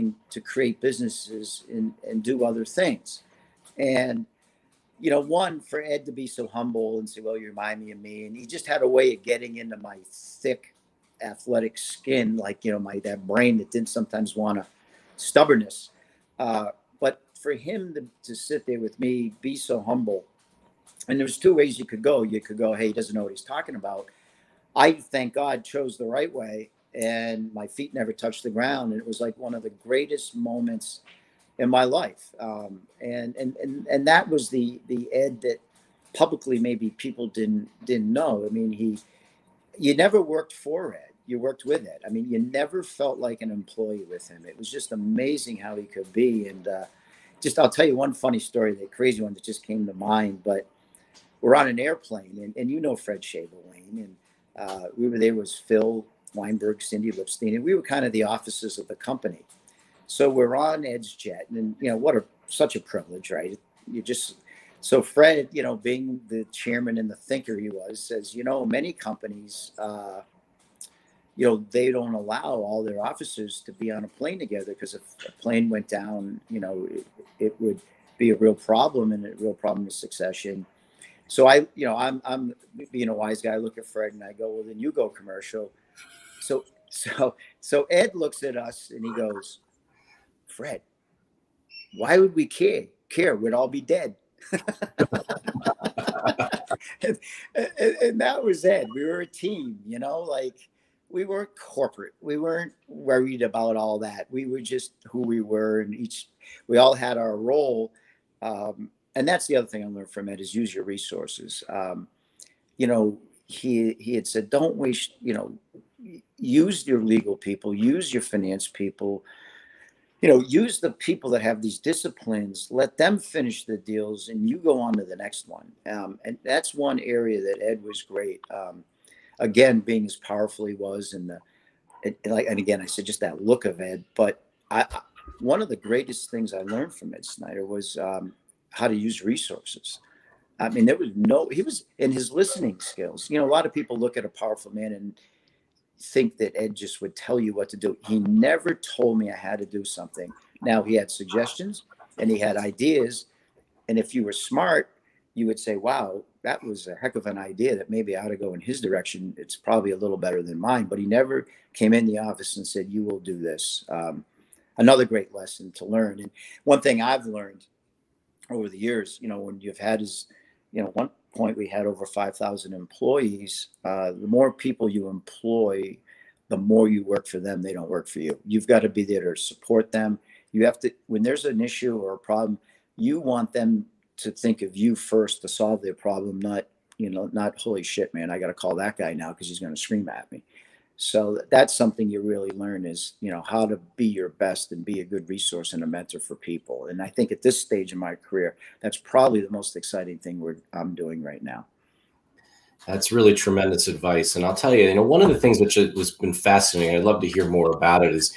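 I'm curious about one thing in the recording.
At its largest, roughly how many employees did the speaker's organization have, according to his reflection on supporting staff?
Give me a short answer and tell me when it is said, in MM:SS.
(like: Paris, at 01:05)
5,000, at 02:52.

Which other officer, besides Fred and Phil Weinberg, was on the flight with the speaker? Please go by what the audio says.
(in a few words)
Cindy Lipstein.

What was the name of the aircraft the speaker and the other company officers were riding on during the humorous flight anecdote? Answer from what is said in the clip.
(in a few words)
EdgeJet.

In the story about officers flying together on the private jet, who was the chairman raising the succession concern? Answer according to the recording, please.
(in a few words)
Fred Shabelane.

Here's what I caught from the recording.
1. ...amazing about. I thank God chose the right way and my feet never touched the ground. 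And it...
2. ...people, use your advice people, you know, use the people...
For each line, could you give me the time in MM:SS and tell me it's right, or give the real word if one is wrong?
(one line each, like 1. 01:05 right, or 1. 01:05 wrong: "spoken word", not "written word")
1. 00:23 wrong: "talking", not "amazing"
2. 01:57 wrong: "finance", not "advice".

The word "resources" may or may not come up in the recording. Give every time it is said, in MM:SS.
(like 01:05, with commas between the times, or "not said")
01:50, 02:19, 03:15.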